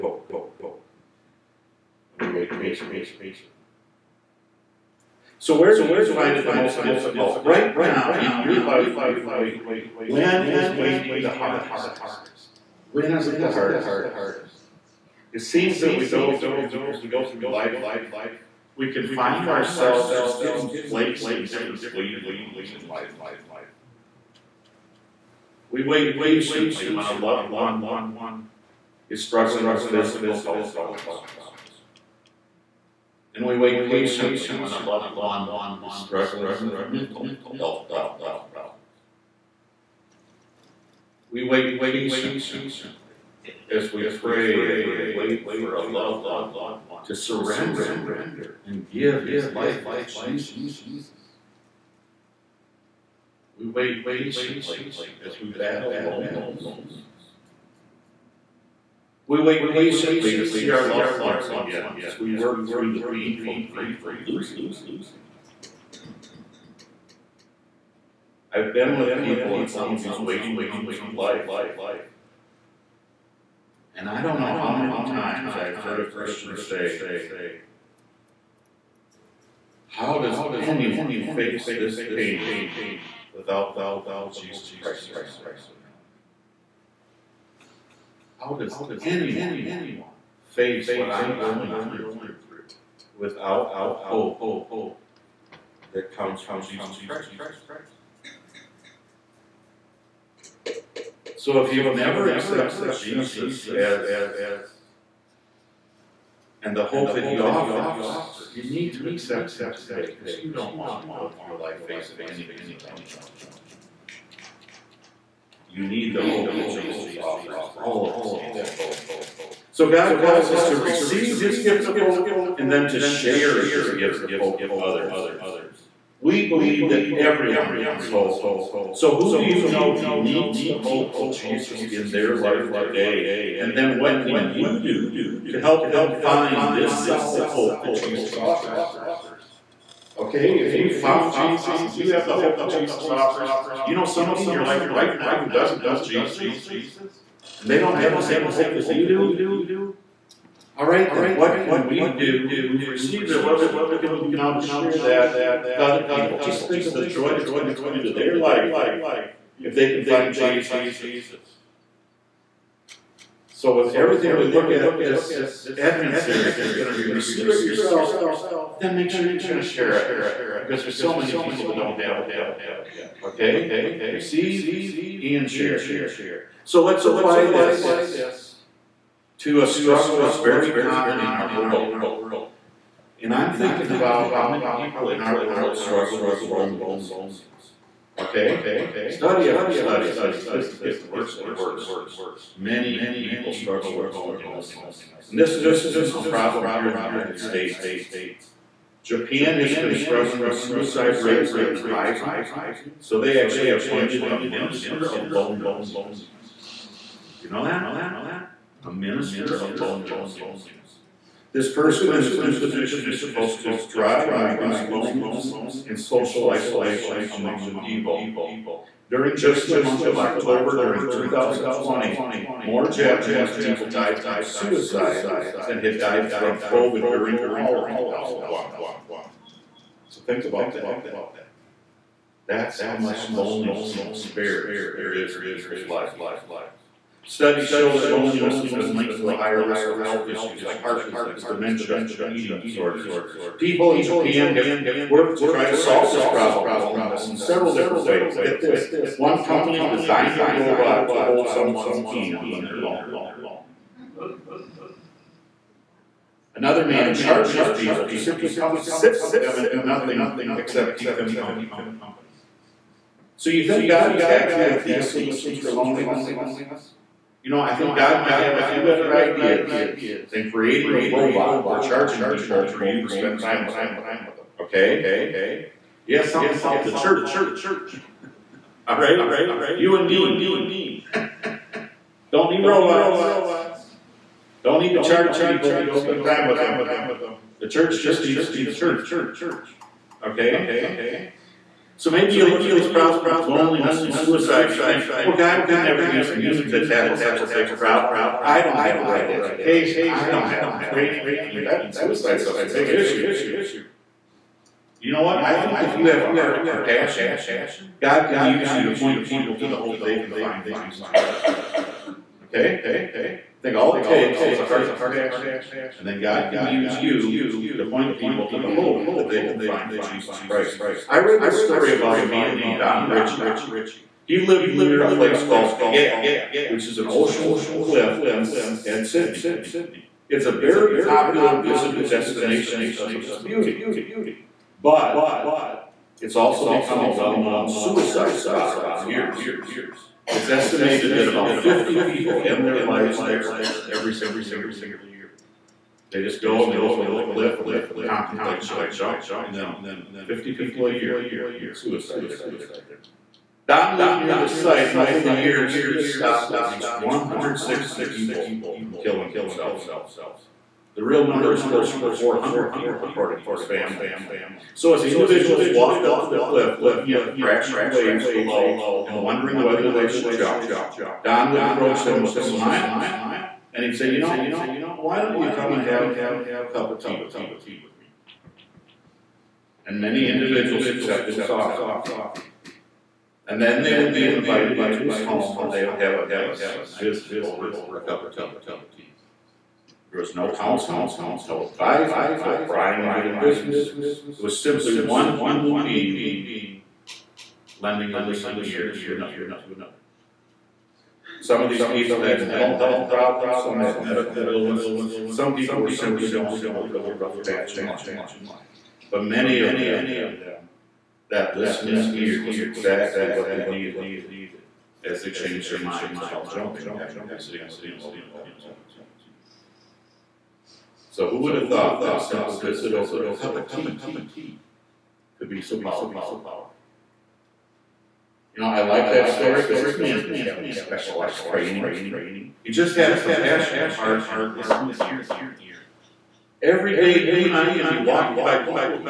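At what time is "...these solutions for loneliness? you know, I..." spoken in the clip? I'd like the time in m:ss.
4:24.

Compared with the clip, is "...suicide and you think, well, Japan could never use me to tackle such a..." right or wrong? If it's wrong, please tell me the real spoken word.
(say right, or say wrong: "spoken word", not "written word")
wrong: "God", not "Japan".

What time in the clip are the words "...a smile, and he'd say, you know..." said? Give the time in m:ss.
6:12.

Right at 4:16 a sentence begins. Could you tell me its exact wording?
Another man charges people to simply come and sit with them and do nothing except keep them company.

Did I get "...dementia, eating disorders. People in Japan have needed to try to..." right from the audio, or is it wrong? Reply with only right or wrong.
wrong.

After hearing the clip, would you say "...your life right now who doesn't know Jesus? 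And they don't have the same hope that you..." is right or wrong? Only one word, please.
right.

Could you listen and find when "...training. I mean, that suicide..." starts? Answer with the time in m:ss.
5:00.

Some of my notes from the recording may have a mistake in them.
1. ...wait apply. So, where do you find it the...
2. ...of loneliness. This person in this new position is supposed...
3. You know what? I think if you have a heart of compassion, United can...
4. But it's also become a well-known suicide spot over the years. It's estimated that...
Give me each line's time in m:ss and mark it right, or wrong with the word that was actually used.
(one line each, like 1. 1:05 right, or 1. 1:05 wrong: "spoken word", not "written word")
1. 0:02 wrong: "patiently", not "apply"
2. 3:29 right
3. 5:05 wrong: "God", not "United"
4. 5:34 right.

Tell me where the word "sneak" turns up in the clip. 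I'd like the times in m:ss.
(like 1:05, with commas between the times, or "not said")
not said.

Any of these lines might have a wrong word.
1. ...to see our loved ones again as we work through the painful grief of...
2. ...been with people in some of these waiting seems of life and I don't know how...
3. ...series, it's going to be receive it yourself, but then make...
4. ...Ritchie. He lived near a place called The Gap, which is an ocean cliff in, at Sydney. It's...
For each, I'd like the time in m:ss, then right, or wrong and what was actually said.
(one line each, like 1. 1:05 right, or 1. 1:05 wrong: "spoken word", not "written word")
1. 1:00 right
2. 1:08 wrong: "rooms", not "seems"
3. 2:46 right
4. 5:23 right.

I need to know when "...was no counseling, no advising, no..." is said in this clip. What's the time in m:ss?
6:30.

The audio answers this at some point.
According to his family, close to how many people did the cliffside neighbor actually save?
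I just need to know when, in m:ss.
6:01.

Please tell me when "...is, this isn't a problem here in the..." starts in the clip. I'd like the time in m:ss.
3:15.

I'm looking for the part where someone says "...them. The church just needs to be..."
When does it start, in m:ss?
4:46.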